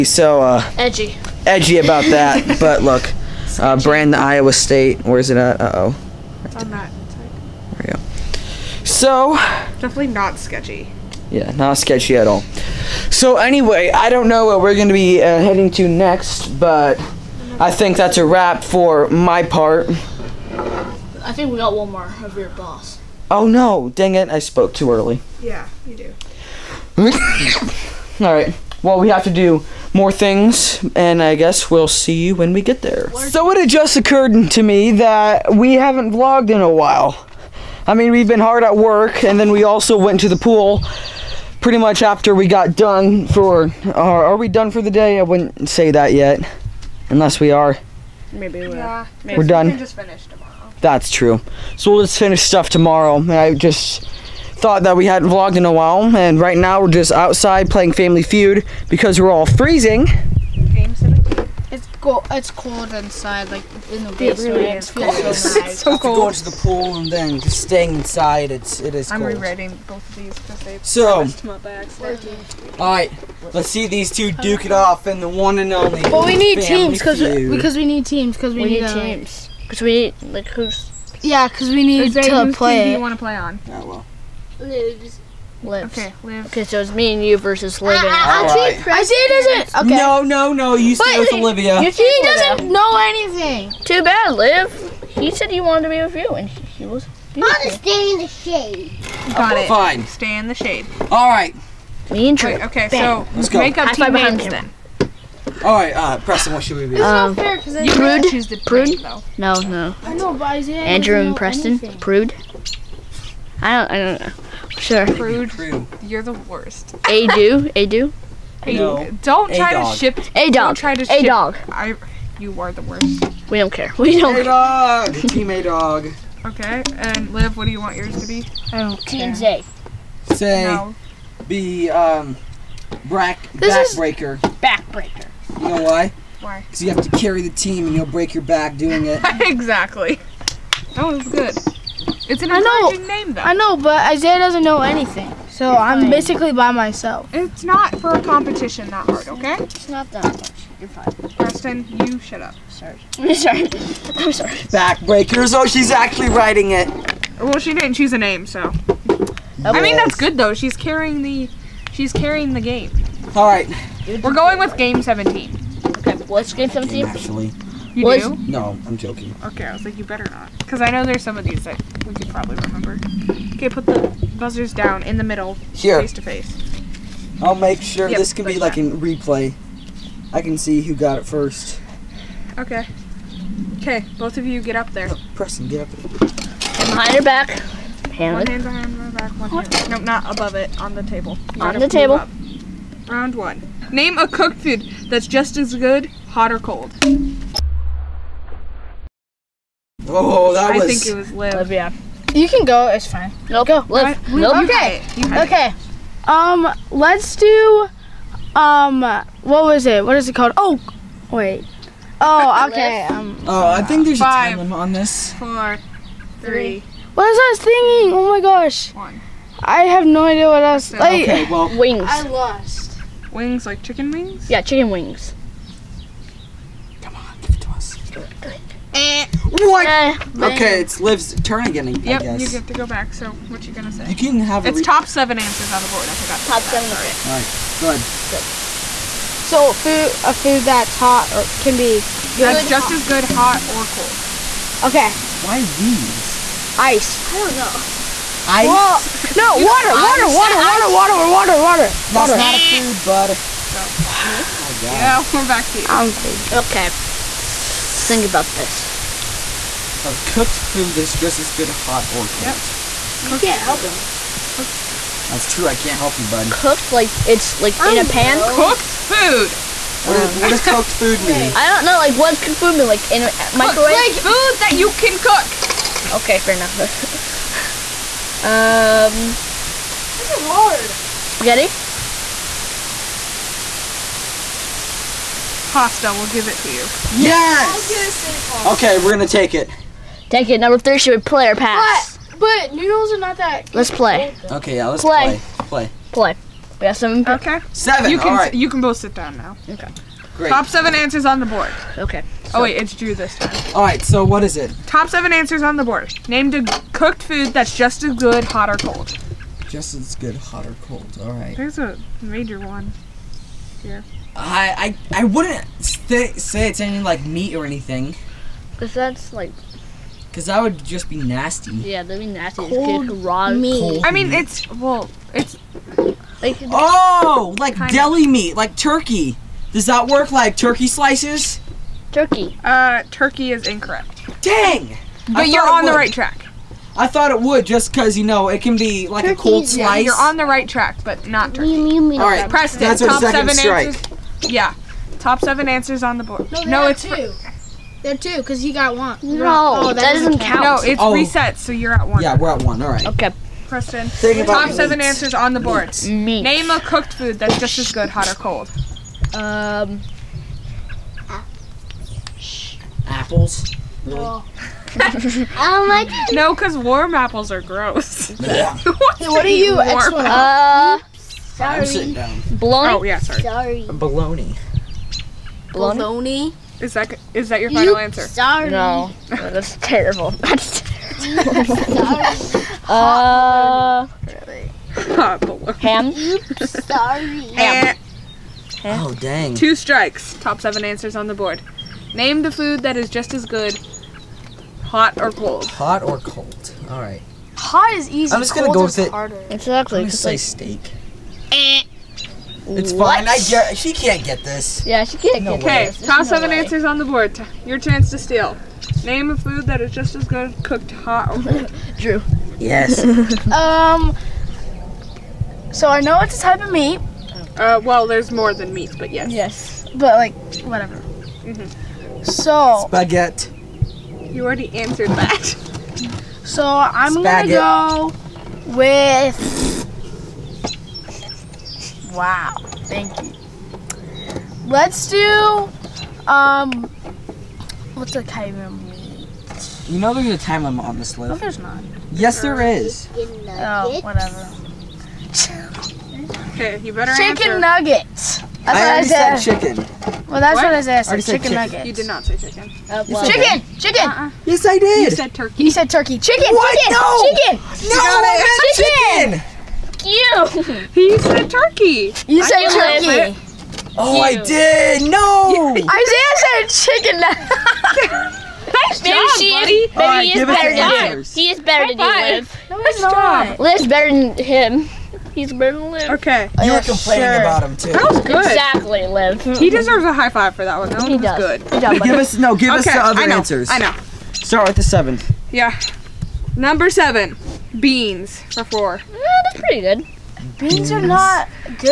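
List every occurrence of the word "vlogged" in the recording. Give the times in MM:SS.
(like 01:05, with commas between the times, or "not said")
00:36, 00:55.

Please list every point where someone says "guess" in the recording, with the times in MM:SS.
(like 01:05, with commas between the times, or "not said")
00:31, 03:52.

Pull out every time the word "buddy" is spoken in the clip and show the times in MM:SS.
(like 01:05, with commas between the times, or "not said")
07:49.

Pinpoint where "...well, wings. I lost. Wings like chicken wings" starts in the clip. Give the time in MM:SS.
03:41.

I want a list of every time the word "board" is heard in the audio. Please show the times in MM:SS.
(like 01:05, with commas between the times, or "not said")
03:55, 05:01, 05:05, 05:46, 05:55, 06:31, 06:47.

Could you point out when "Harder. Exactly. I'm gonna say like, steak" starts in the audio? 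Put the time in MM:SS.
06:39.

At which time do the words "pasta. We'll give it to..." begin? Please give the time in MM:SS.
04:45.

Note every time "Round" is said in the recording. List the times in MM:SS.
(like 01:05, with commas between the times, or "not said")
03:13.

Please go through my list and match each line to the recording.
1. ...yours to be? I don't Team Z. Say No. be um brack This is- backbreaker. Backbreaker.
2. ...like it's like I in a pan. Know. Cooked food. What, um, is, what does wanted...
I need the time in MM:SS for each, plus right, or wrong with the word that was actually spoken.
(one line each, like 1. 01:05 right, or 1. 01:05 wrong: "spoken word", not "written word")
1. 02:07 right
2. 04:26 wrong: "cooked", not "wanted".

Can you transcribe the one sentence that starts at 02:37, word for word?
Well, she didn't choose a name, so.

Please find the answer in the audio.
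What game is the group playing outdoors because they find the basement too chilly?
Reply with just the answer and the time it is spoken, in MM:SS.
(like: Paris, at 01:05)
Family Feud, at 00:57.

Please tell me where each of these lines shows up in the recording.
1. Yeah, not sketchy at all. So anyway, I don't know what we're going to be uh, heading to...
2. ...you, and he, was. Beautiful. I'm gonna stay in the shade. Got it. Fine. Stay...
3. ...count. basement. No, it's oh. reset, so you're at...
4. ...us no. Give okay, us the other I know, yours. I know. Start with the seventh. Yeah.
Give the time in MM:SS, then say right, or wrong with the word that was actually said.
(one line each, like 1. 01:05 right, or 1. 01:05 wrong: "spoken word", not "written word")
1. 00:11 right
2. 01:36 right
3. 05:50 wrong: "count", not "basement"
4. 08:02 wrong: "answers", not "yours".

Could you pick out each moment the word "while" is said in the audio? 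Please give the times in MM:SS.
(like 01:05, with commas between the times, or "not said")
00:36, 00:55.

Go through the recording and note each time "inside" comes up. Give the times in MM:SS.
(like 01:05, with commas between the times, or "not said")
01:02, 01:07.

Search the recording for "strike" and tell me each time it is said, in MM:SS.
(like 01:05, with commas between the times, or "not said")
05:43, 06:29.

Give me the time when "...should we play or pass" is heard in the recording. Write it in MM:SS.
04:50.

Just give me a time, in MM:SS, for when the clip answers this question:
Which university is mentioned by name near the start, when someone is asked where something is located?
00:04.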